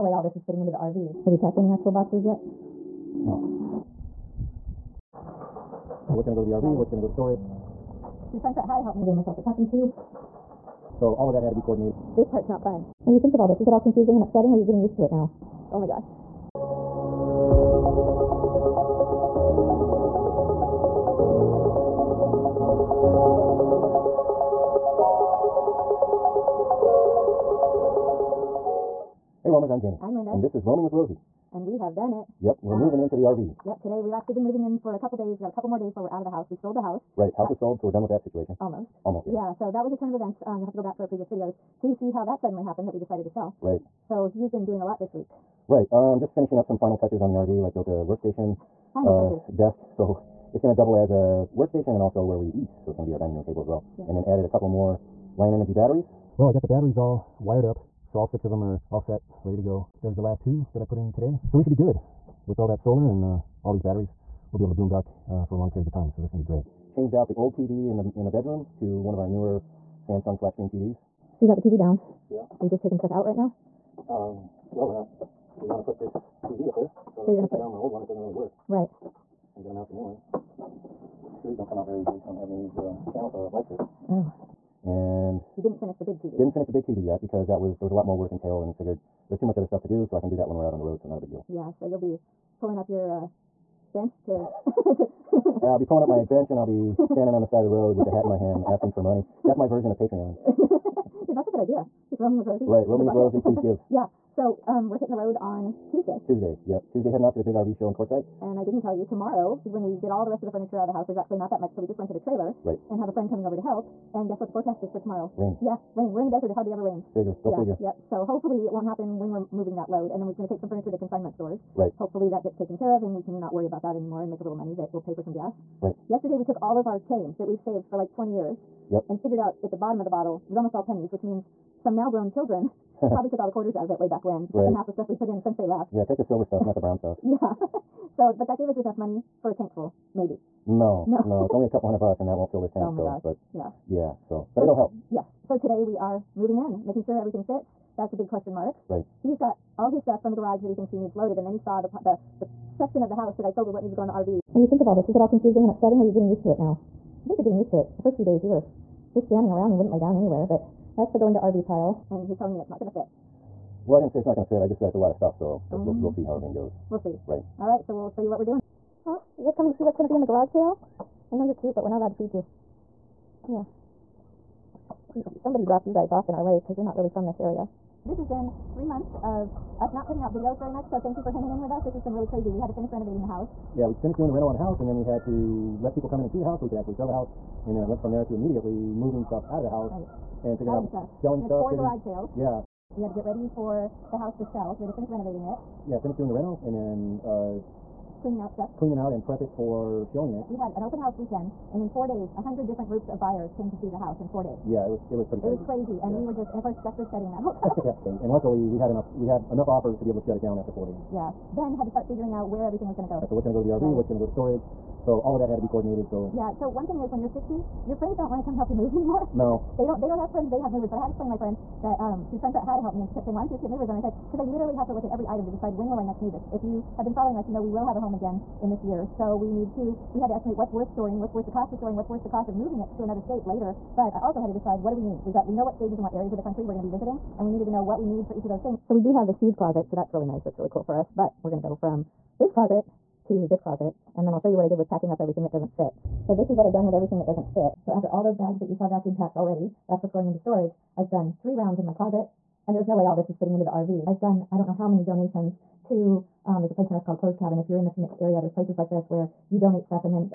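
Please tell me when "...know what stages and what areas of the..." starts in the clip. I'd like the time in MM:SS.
03:55.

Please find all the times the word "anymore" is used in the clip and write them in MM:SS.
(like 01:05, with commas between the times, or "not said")
02:03, 03:38.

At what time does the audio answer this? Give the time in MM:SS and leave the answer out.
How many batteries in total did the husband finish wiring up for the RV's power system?
00:58.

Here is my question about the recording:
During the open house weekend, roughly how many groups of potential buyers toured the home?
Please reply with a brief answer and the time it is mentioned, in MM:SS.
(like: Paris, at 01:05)
100, at 03:22.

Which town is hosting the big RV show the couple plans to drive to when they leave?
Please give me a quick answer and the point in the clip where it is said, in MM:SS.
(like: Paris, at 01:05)
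Quartzsite, at 01:47.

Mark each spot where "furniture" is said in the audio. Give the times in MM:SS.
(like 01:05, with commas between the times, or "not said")
01:50, 02:00.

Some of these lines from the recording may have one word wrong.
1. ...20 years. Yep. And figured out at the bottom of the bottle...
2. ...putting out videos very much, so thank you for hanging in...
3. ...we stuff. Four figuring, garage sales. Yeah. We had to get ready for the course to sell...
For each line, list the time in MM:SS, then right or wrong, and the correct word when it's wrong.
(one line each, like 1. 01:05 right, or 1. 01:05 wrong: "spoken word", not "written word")
1. 02:08 right
2. 03:00 right
3. 03:11 wrong: "house", not "course".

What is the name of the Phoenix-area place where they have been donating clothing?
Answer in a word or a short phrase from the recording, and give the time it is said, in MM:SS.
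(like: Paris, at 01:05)
Clothes Cabin, at 04:17.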